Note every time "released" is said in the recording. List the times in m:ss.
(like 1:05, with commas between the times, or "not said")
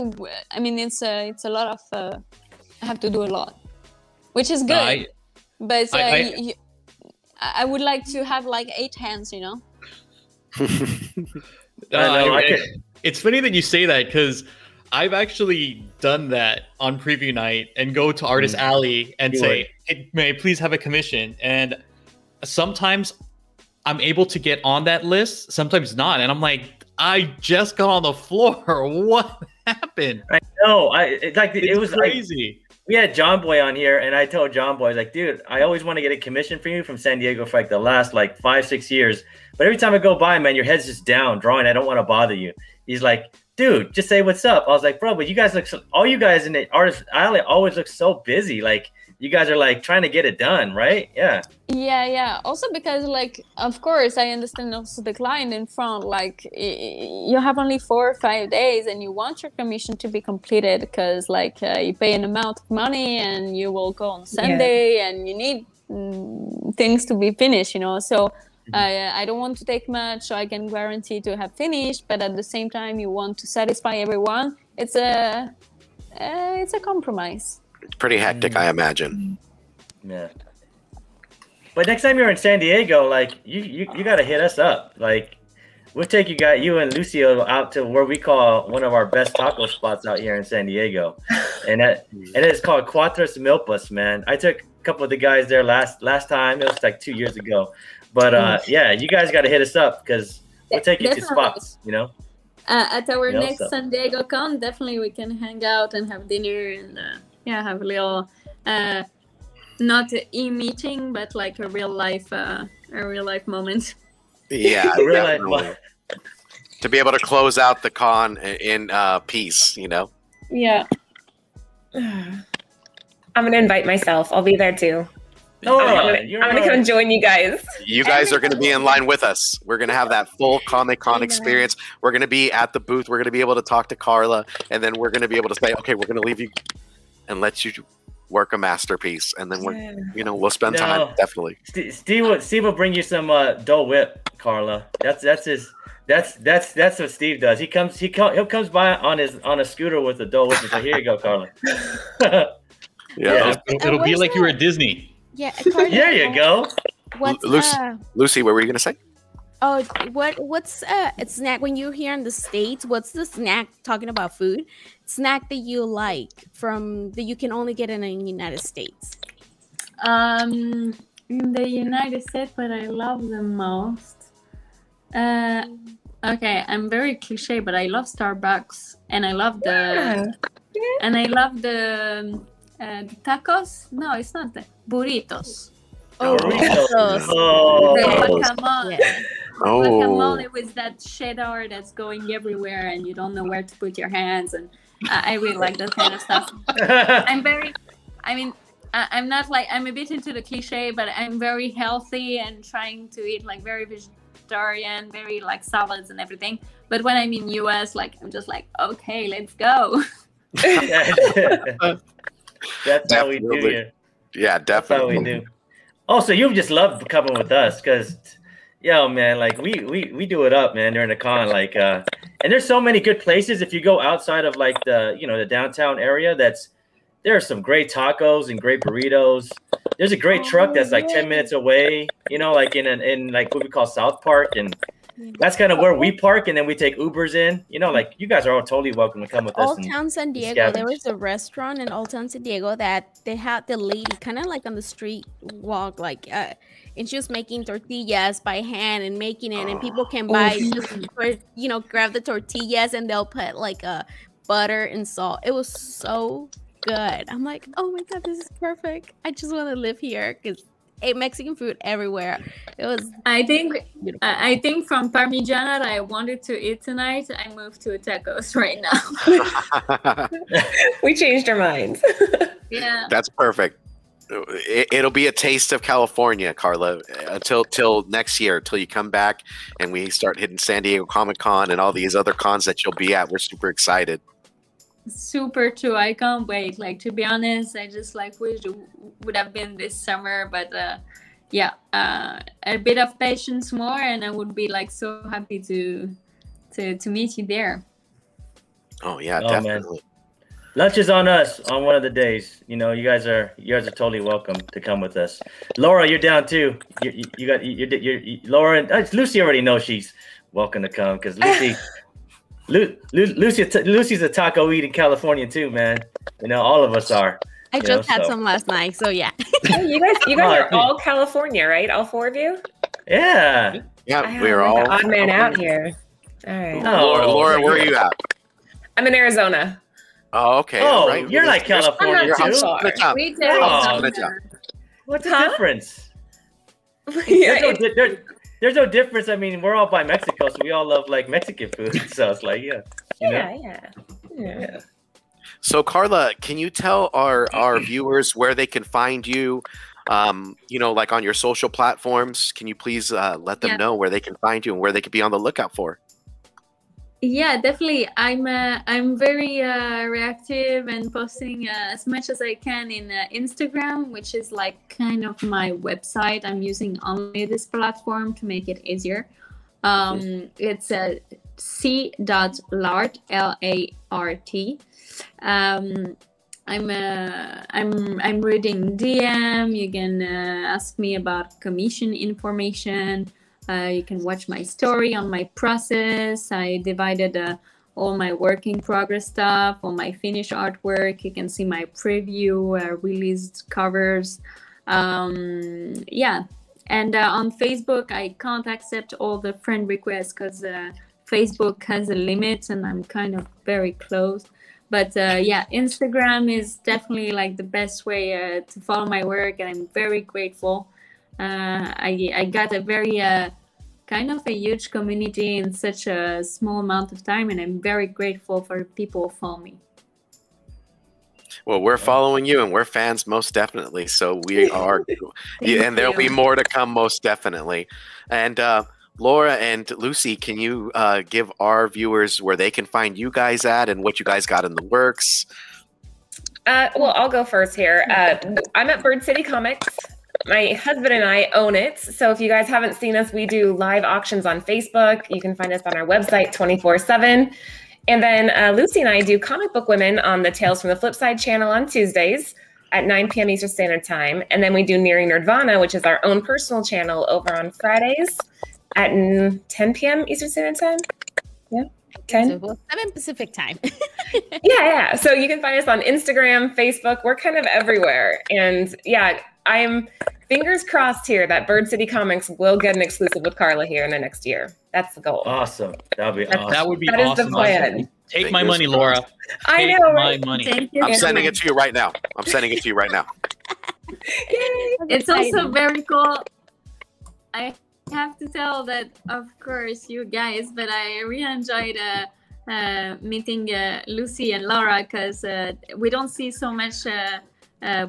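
6:32.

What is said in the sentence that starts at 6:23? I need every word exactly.
Uh, you can watch my story on my process.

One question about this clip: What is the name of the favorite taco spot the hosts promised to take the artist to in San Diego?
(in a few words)
Cuatros Milpas.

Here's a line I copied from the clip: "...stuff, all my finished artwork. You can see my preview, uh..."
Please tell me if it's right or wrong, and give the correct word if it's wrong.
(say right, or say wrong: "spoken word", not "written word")
right.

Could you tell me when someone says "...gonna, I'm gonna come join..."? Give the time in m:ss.
2:06.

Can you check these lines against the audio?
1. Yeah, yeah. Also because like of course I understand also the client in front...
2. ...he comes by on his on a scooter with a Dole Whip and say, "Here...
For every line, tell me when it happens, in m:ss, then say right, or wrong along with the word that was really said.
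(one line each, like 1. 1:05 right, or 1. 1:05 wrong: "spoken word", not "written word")
1. 0:51 right
2. 2:28 right.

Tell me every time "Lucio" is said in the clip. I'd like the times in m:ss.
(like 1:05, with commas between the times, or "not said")
1:26.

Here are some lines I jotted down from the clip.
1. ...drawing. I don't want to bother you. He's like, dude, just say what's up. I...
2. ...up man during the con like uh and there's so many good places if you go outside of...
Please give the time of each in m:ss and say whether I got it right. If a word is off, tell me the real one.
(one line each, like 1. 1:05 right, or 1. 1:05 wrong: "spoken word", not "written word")
1. 0:41 right
2. 3:40 right.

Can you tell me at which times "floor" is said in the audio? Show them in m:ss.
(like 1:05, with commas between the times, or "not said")
0:28.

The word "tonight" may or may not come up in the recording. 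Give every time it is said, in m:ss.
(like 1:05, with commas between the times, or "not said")
4:26.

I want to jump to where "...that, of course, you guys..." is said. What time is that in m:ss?
8:08.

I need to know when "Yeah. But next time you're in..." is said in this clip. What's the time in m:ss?
1:20.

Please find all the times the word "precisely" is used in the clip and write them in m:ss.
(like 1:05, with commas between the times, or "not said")
not said.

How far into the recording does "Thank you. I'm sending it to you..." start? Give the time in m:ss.
8:00.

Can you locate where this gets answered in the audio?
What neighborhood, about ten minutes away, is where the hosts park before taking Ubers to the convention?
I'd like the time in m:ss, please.
3:53.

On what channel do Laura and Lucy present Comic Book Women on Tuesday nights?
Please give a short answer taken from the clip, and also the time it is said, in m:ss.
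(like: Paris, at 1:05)
Tales from the Flipside, at 7:30.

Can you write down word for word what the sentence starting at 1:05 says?
and you need mm, things to be finished, you know.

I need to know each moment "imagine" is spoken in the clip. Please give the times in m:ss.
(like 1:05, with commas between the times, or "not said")
1:18.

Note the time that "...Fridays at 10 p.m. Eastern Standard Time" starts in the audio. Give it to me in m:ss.
7:37.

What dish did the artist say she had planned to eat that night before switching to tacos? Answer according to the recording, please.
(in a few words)
Parmigiana.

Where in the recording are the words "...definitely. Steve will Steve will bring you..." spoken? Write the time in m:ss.
2:21.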